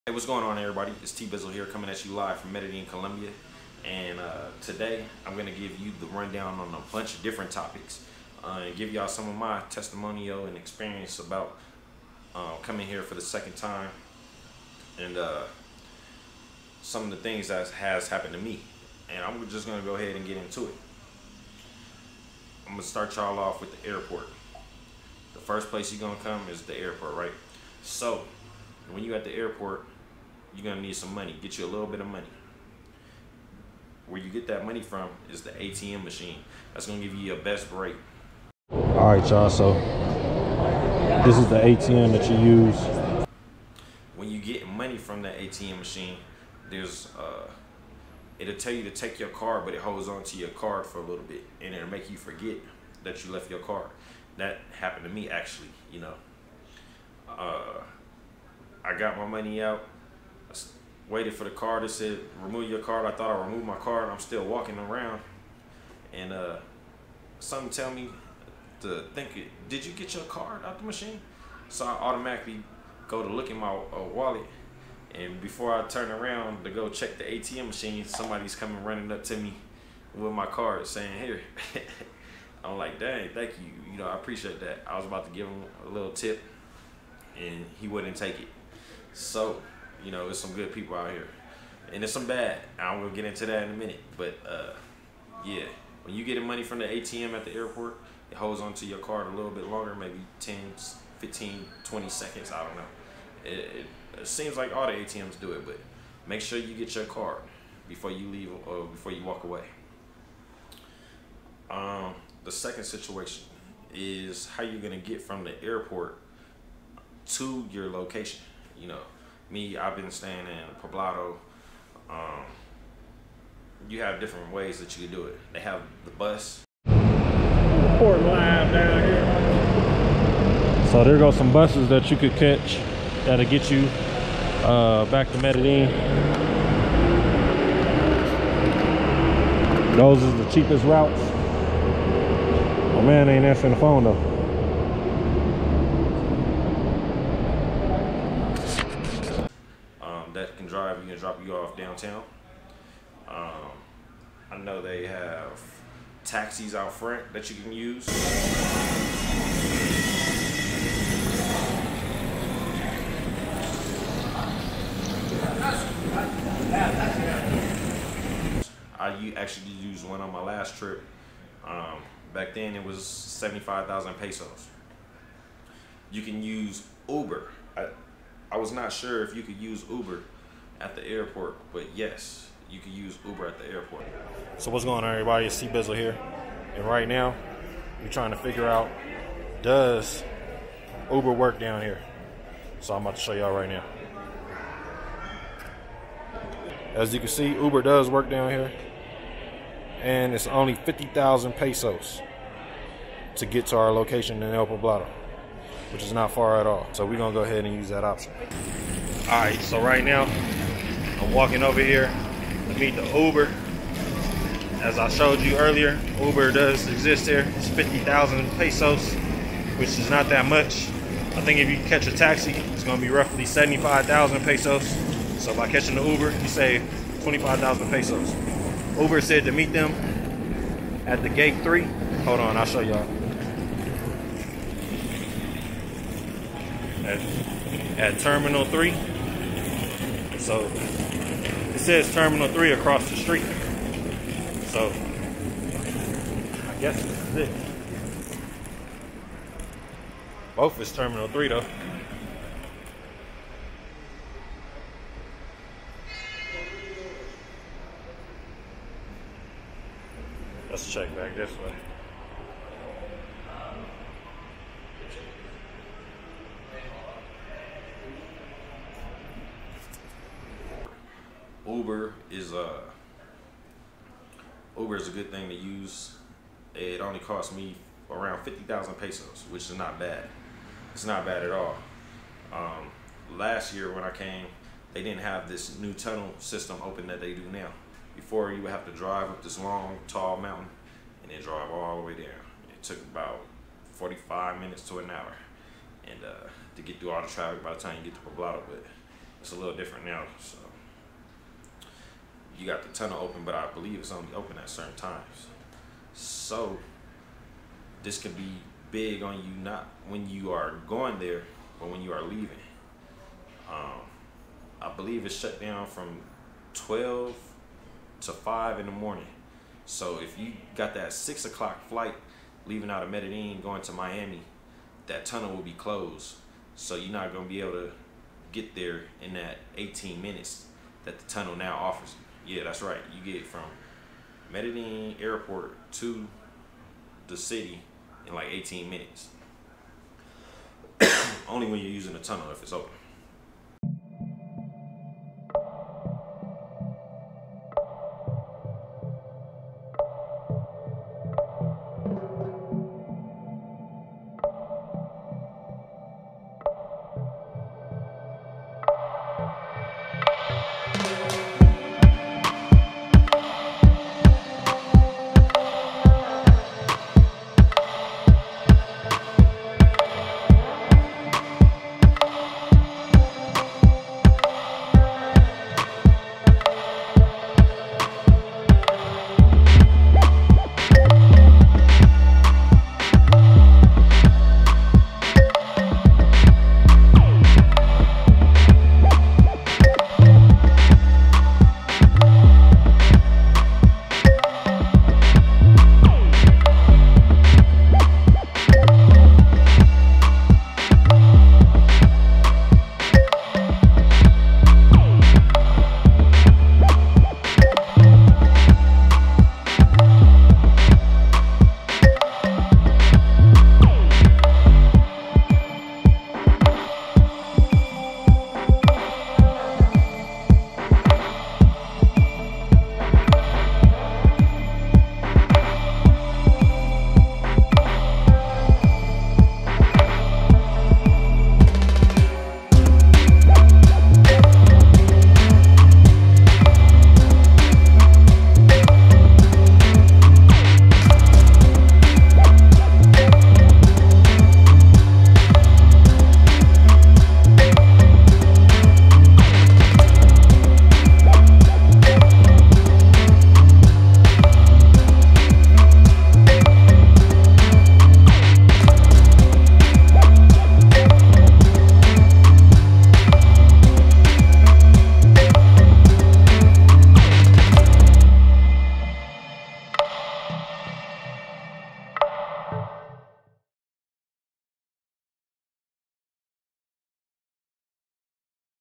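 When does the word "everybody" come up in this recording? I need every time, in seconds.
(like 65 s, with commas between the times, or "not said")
0 s, 185 s.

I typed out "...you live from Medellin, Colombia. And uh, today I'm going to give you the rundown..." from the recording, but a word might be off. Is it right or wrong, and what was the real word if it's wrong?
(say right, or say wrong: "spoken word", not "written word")
right.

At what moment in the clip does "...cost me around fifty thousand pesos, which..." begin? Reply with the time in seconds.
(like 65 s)
277 s.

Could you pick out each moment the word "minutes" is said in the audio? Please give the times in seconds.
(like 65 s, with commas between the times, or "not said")
93 s, 294 s, 330 s, 338 s.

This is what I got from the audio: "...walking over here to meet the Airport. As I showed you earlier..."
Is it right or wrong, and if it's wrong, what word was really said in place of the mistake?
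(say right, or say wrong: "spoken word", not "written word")
wrong: "Uber", not "Airport".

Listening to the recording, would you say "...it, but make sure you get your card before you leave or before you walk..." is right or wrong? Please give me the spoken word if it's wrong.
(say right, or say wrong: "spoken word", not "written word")
right.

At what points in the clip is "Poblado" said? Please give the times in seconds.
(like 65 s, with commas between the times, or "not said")
120 s, 204 s, 298 s.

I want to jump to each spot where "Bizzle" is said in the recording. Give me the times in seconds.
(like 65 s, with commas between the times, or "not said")
1 s, 185 s.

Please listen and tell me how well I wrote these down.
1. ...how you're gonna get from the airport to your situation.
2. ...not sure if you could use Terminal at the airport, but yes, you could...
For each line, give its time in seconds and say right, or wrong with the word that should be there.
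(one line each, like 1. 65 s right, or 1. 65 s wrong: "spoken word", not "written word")
1. 114 s wrong: "location", not "situation"
2. 178 s wrong: "Uber", not "Terminal".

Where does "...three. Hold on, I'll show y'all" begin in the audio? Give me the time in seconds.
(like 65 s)
231 s.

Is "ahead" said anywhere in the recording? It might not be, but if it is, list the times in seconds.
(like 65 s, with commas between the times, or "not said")
19 s, 207 s.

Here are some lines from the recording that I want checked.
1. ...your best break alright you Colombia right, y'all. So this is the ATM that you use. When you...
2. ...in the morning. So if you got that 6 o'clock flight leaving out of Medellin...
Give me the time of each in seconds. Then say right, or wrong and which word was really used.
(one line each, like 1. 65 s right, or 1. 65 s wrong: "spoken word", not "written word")
1. 37 s wrong: "All", not "Colombia"
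2. 318 s right.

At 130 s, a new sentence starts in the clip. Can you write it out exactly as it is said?
So there go some buses that you could catch that'll get you uh, back to Medellin.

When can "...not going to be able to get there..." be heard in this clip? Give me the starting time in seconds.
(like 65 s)
327 s.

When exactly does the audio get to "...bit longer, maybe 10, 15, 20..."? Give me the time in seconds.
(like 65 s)
99 s.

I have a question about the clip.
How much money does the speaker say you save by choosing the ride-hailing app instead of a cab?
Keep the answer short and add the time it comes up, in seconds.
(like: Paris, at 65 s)
25,000 pesos, at 227 s.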